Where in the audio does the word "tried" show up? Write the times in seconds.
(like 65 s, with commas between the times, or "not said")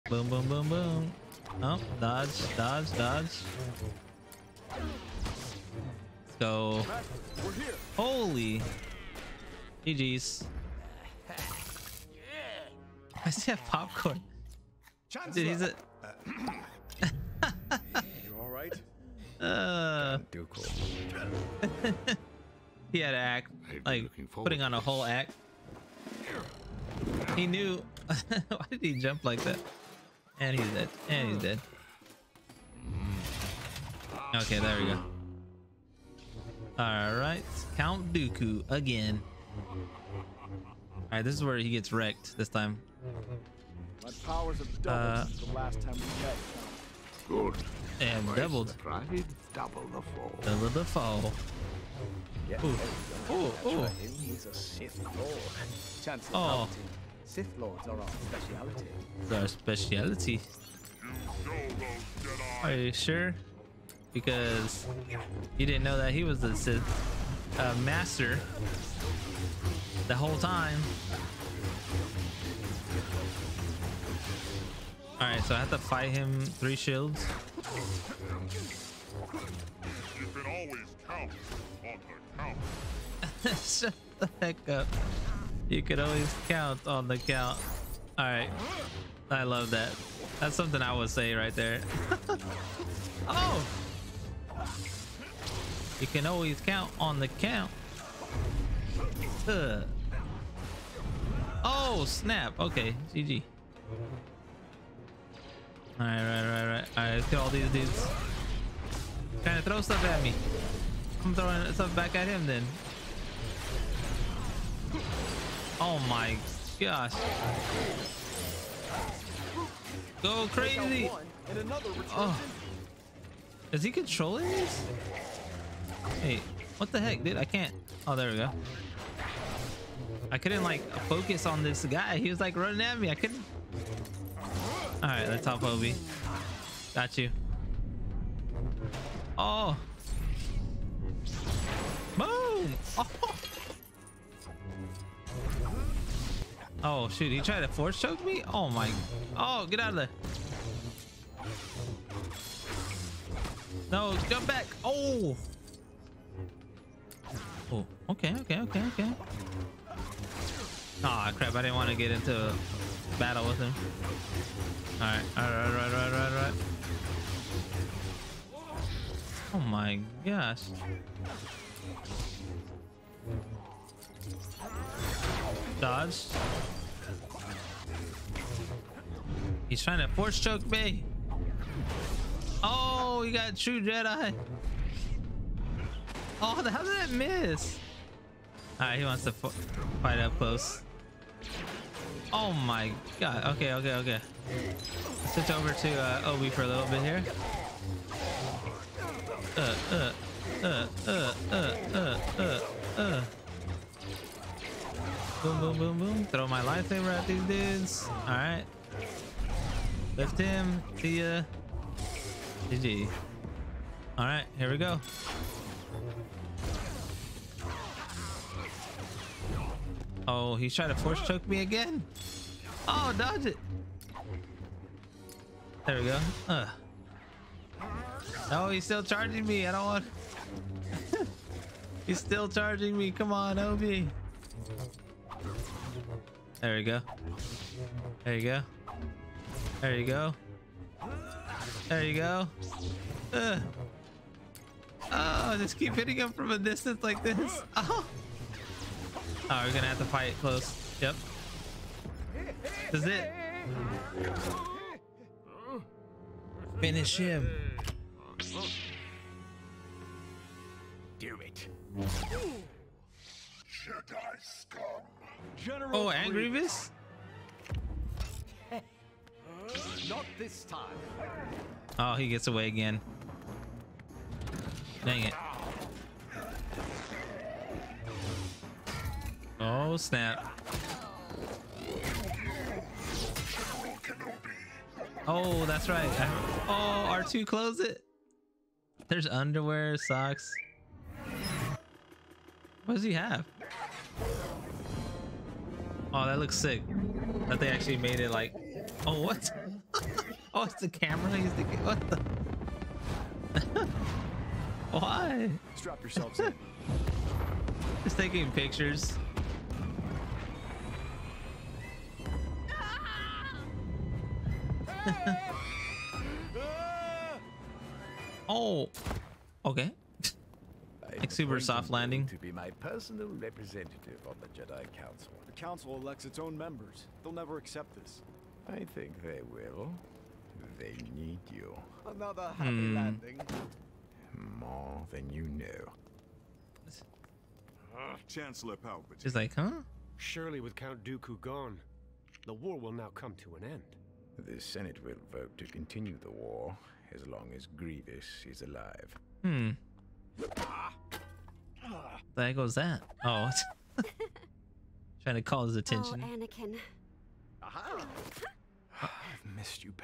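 147 s.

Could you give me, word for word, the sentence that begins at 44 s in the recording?
My powers have doubled uh, since the last time we met.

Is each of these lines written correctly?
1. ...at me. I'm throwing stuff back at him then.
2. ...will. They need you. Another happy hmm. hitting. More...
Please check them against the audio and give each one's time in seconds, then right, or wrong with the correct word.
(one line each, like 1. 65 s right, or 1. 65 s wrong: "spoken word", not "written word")
1. 110 s right
2. 329 s wrong: "landing", not "hitting".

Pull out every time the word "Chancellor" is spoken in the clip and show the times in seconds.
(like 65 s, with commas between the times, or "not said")
56 s, 338 s.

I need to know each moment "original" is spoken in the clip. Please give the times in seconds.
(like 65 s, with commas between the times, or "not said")
not said.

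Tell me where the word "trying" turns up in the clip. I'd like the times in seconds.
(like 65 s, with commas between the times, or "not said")
109 s, 179 s, 220 s, 355 s.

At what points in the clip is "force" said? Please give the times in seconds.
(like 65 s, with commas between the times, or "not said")
147 s, 180 s, 220 s.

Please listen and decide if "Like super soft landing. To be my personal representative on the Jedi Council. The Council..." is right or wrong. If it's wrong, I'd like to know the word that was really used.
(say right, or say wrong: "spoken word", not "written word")
right.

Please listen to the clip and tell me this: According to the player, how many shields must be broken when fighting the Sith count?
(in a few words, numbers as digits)
Three.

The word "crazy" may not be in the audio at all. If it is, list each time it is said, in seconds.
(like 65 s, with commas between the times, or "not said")
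120 s.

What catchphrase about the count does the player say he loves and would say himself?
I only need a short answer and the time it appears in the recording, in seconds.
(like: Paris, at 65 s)
You could always count on the count, at 85 s.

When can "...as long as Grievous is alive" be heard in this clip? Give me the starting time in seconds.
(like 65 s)
347 s.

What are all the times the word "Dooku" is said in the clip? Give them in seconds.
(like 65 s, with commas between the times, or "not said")
38 s, 341 s.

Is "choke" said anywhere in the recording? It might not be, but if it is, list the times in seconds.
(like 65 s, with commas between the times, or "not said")
147 s, 180 s, 221 s.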